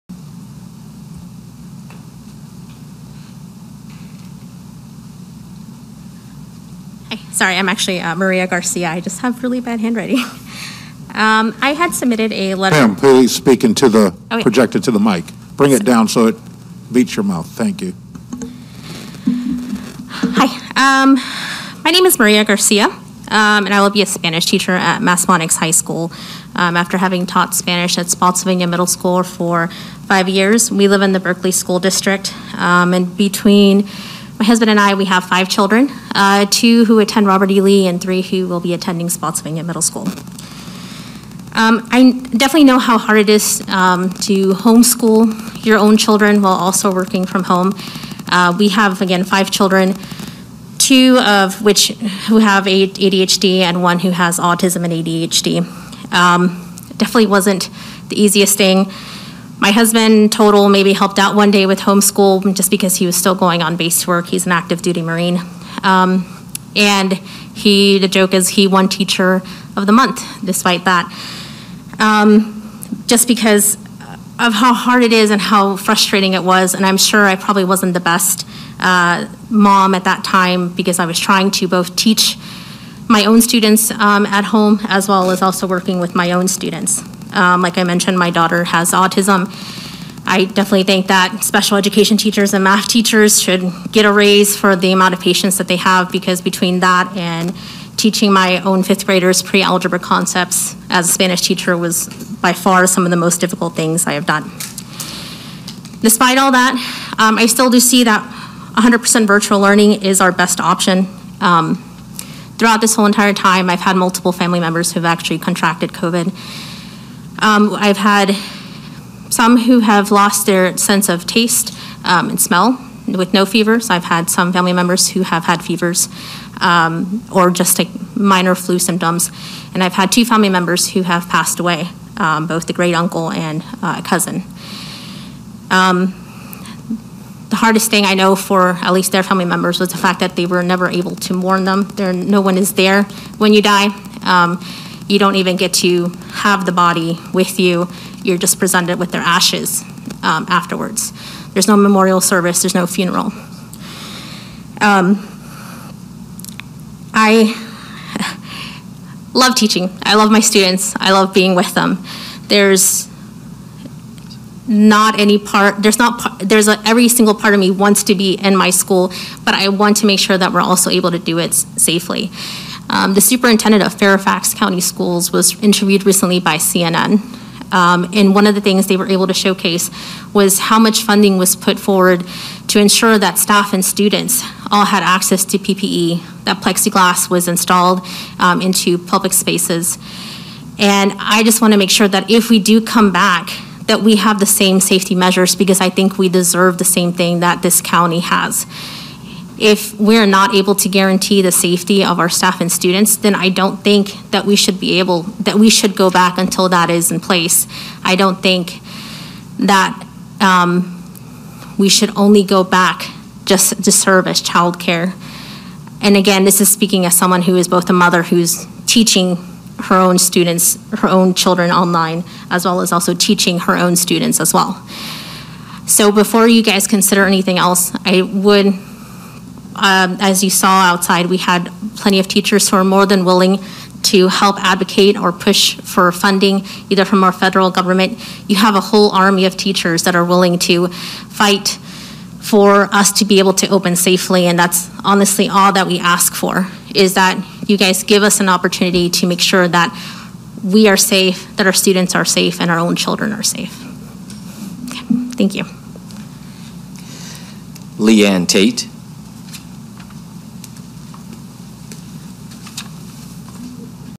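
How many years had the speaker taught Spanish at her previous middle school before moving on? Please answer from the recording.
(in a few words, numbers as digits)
5.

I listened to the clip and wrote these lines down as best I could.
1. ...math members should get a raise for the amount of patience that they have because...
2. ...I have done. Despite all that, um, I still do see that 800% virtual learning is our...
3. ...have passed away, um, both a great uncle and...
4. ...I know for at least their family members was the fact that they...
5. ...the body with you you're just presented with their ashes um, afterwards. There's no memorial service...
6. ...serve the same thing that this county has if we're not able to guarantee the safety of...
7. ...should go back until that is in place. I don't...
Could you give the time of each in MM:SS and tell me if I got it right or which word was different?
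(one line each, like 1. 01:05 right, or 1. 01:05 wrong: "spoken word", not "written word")
1. 01:32 wrong: "teachers", not "members"
2. 01:44 wrong: "100", not "800"
3. 02:11 right
4. 02:18 right
5. 02:26 right
6. 03:16 wrong: "deserve", not "serve"
7. 03:25 right.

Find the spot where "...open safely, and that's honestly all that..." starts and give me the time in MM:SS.
04:03.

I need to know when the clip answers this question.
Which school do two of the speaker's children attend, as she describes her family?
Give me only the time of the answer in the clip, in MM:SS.
00:37.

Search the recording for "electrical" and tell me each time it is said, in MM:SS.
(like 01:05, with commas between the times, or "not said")
not said.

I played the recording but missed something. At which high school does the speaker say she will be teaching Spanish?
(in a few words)
Massaponax High School.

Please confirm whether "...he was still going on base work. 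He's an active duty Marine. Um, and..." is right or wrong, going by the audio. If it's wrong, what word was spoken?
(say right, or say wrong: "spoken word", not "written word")
right.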